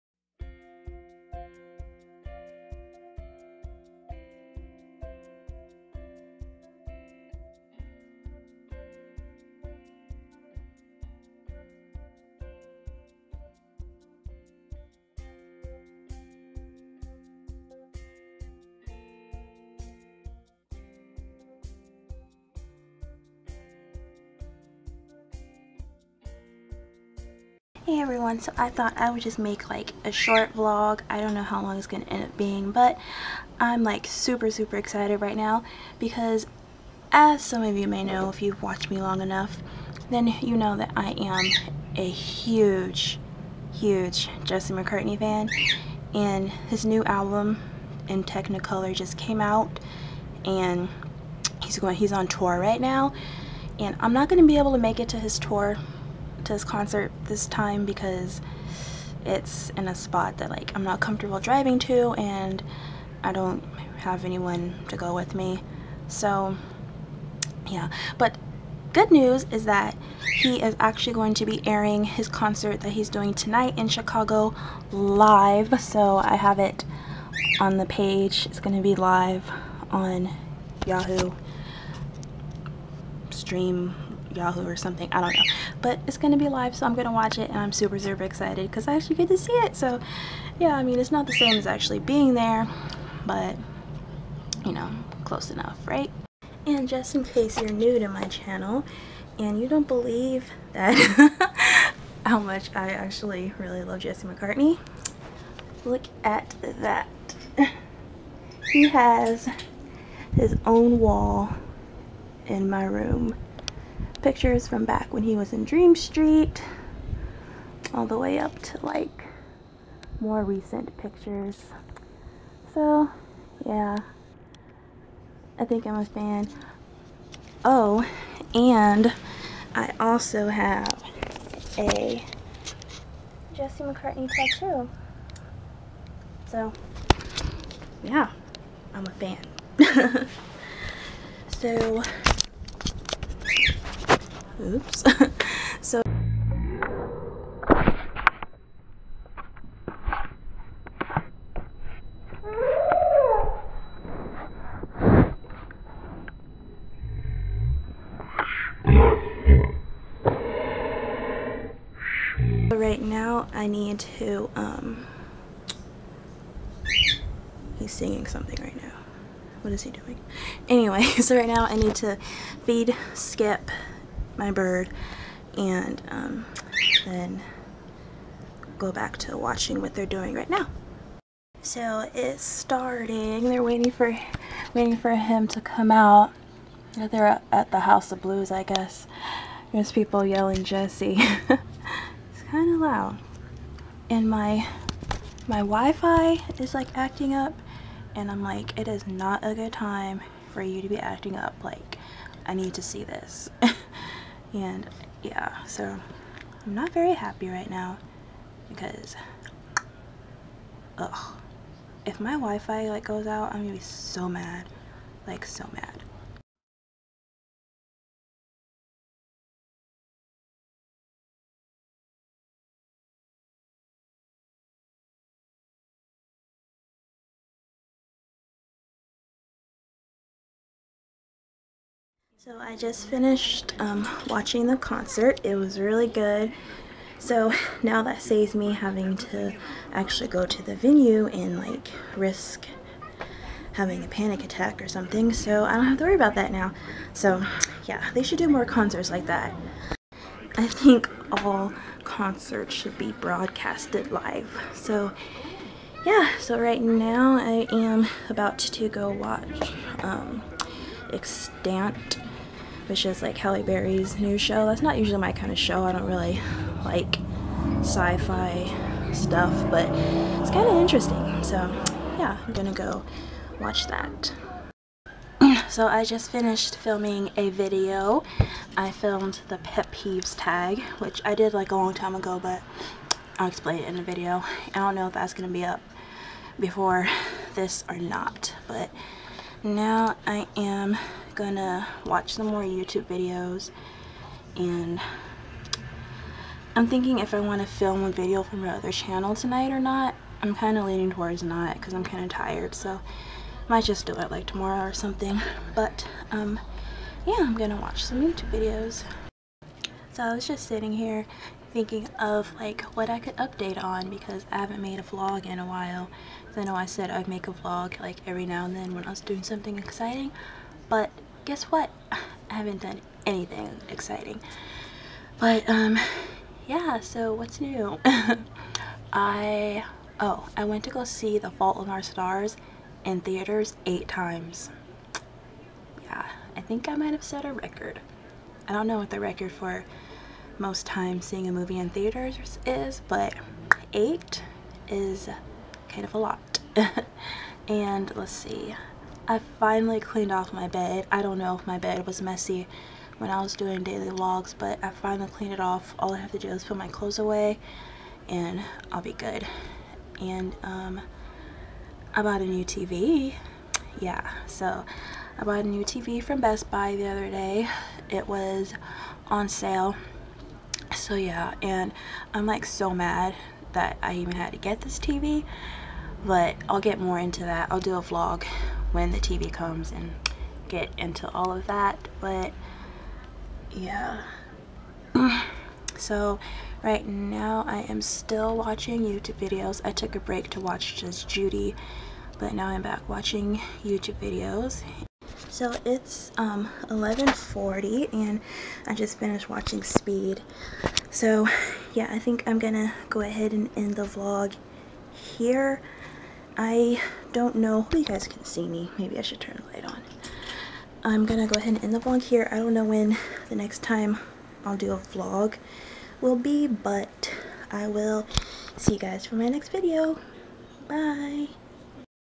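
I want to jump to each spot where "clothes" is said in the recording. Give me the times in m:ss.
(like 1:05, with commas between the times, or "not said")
5:56.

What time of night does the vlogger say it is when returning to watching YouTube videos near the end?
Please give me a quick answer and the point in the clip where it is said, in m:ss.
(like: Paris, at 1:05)
11:40, at 6:36.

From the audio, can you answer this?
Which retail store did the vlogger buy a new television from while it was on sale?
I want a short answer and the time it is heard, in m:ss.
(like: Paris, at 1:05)
Best Buy, at 6:06.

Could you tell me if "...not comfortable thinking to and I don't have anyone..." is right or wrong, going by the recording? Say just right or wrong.
wrong.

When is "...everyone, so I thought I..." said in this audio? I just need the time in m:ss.
0:27.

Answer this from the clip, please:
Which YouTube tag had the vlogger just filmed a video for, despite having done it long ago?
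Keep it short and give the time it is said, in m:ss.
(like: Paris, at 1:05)
Pet peeves tag, at 4:39.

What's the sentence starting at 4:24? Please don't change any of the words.
That's not usually my kind of show.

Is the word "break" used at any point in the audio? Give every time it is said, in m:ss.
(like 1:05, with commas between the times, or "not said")
6:30.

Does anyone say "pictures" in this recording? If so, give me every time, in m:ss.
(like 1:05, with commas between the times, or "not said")
1:54, 2:00.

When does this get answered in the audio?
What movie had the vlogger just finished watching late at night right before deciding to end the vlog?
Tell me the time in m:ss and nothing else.
6:39.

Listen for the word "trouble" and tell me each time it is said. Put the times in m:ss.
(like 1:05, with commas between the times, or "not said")
not said.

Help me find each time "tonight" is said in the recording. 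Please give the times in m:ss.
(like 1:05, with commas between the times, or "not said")
1:13, 4:59.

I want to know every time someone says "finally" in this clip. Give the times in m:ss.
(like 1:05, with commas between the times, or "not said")
5:49, 5:54.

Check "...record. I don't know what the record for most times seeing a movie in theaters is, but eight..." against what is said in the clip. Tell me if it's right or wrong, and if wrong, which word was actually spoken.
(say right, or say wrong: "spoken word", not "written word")
right.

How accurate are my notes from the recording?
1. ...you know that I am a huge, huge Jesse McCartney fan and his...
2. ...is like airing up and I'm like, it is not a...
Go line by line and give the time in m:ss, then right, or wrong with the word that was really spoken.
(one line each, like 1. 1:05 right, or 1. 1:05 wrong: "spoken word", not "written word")
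1. 0:40 right
2. 3:16 wrong: "acting", not "airing".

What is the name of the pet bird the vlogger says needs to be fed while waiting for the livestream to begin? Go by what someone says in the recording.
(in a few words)
Skip.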